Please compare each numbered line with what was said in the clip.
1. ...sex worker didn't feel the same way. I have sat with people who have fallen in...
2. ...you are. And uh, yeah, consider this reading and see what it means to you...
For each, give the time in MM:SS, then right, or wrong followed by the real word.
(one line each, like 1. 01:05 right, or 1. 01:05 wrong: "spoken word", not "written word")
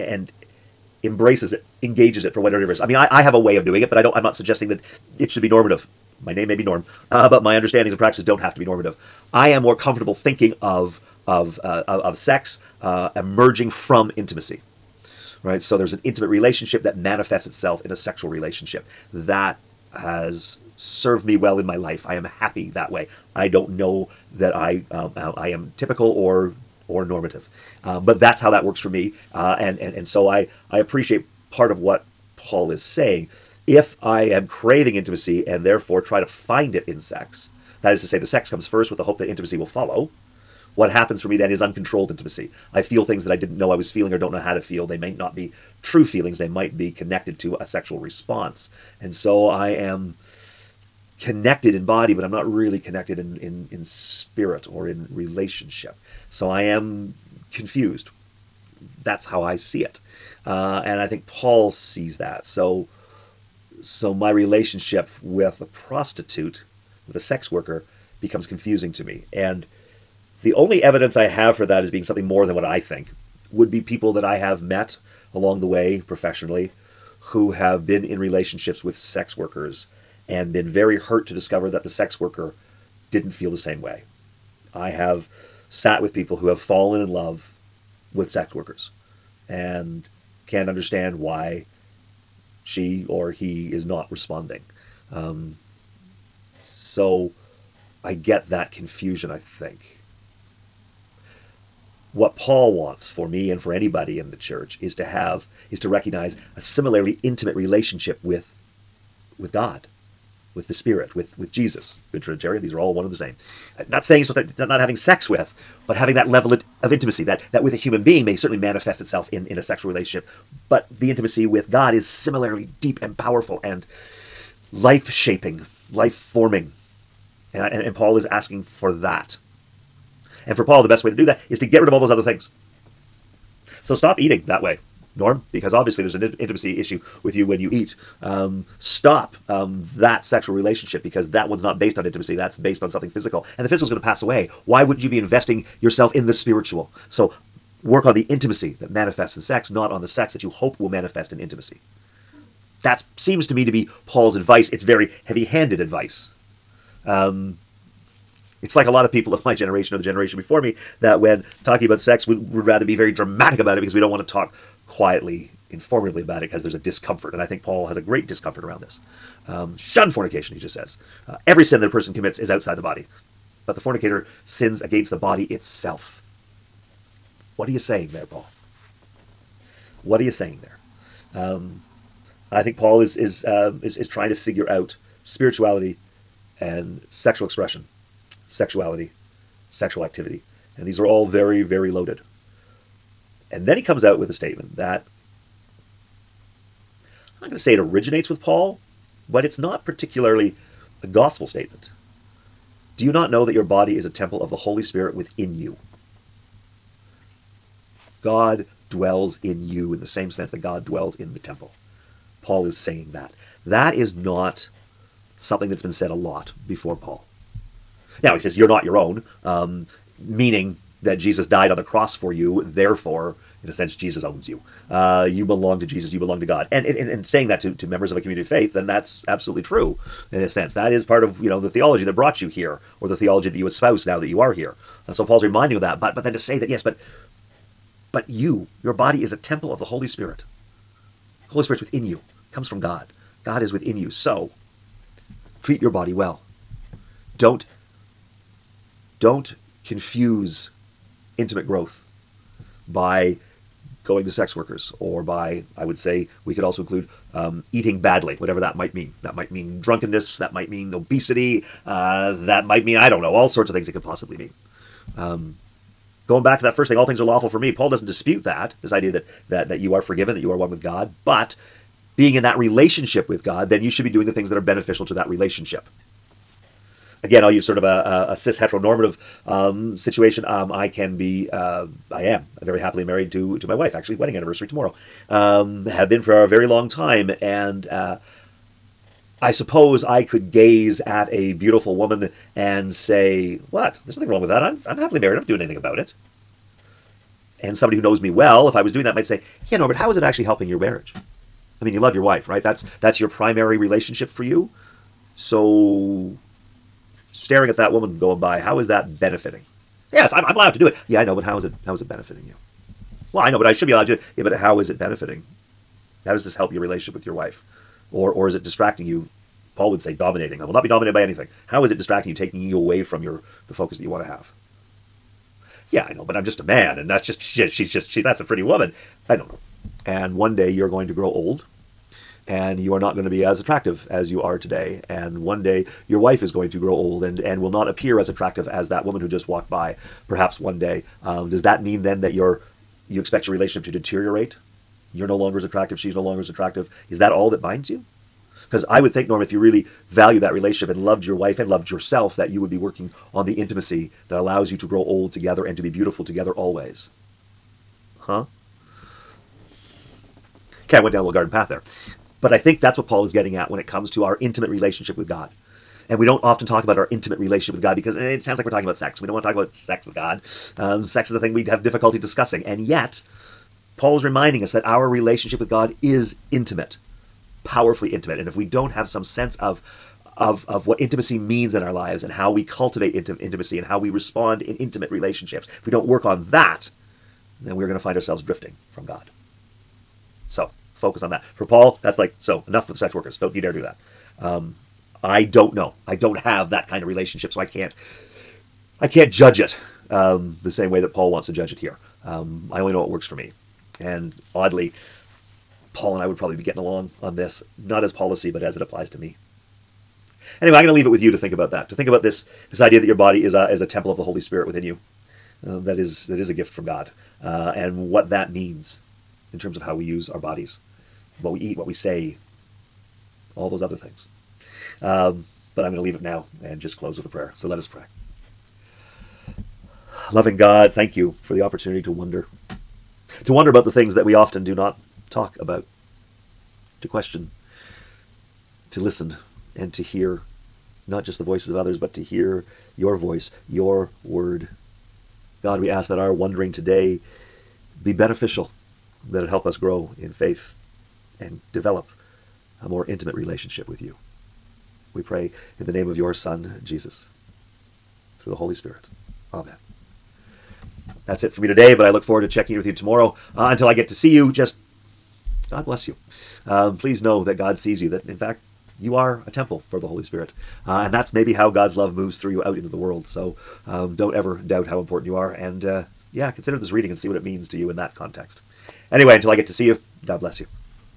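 1. 01:21 right
2. 07:55 right.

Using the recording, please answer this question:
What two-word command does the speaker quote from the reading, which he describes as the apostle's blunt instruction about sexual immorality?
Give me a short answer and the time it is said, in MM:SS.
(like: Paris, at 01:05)
Shun fornication, at 02:49.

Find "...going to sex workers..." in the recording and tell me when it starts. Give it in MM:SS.
04:14.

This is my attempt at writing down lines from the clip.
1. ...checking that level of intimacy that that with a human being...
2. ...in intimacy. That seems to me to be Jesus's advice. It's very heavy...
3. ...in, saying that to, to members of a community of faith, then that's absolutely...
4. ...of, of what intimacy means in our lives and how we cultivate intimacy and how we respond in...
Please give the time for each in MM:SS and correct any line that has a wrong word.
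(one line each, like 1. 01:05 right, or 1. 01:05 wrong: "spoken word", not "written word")
1. 01:55 wrong: "having", not "checking"
2. 02:31 wrong: "Paul", not "Jesus"
3. 03:46 right
4. 06:20 right.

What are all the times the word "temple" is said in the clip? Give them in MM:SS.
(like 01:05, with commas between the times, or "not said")
03:24, 03:31, 03:59, 06:53, 07:49.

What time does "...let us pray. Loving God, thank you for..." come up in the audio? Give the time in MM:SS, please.
07:07.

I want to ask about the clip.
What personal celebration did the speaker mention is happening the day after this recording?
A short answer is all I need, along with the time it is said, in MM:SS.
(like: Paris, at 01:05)
Wedding anniversary, at 04:44.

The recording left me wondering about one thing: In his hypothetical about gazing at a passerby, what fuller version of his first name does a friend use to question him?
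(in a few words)
Norbert.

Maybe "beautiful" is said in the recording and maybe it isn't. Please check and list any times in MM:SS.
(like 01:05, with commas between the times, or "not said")
04:51, 05:55.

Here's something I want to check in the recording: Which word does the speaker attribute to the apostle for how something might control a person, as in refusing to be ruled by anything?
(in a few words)
dominating.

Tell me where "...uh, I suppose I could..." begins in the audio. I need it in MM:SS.
04:47.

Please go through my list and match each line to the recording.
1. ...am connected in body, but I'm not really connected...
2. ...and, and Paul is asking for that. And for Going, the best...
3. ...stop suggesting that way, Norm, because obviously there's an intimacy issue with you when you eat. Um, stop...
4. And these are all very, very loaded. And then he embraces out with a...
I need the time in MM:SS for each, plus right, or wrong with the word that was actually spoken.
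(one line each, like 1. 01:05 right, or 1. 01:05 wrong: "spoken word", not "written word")
1. 00:49 right
2. 02:07 wrong: "Paul", not "Going"
3. 02:13 wrong: "eating", not "suggesting"
4. 03:10 wrong: "comes", not "embraces".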